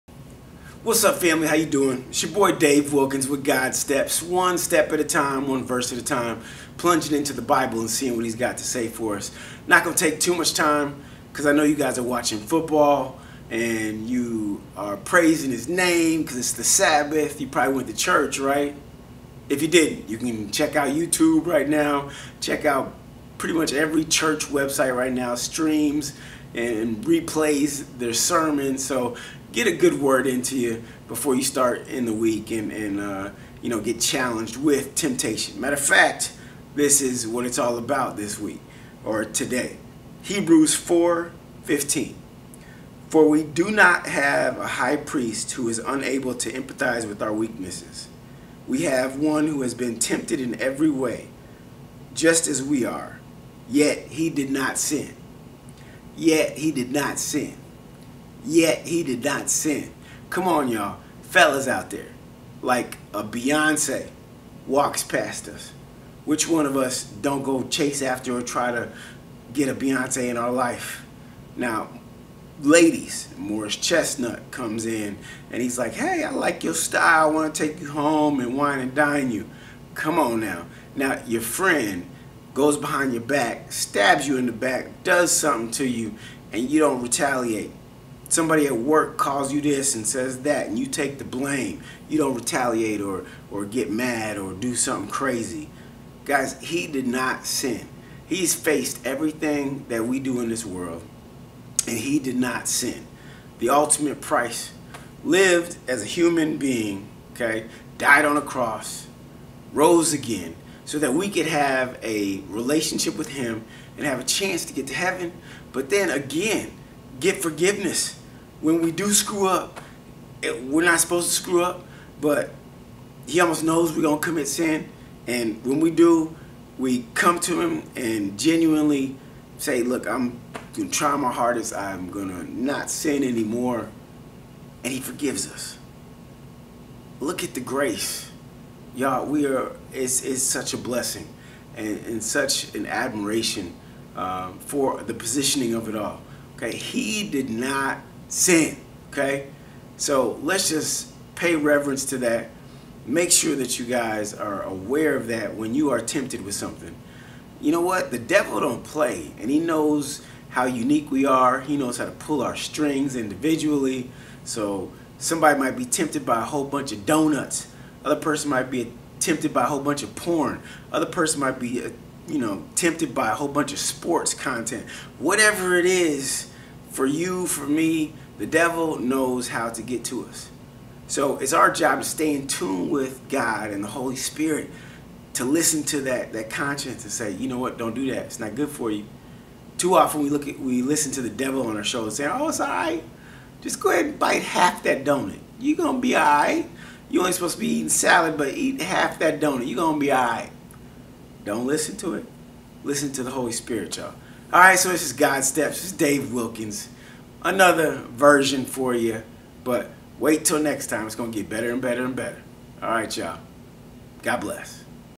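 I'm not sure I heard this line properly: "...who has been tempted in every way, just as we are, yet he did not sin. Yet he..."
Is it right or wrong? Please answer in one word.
right.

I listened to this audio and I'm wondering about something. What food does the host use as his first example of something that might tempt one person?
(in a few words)
Donuts.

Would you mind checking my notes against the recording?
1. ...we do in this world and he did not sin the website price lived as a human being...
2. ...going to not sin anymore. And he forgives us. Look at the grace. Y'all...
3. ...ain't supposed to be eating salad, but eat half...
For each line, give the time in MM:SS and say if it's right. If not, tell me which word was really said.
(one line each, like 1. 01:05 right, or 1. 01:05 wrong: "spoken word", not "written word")
1. 01:40 wrong: "ultimate", not "website"
2. 02:12 right
3. 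03:17 right.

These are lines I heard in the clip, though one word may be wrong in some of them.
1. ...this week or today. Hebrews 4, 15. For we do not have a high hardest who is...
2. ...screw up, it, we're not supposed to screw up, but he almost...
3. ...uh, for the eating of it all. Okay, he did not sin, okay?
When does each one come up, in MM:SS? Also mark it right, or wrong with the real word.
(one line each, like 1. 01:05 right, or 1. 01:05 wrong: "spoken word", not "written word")
1. 00:38 wrong: "priest", not "hardest"
2. 01:59 right
3. 02:24 wrong: "positioning", not "eating".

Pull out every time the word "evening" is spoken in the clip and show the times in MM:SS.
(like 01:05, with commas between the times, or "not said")
not said.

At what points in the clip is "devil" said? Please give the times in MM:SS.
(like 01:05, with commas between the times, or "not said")
02:38, 02:58, 03:11.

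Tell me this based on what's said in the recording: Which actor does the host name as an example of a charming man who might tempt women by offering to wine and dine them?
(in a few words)
Morris Chestnut.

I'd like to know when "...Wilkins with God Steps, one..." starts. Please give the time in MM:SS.
00:02.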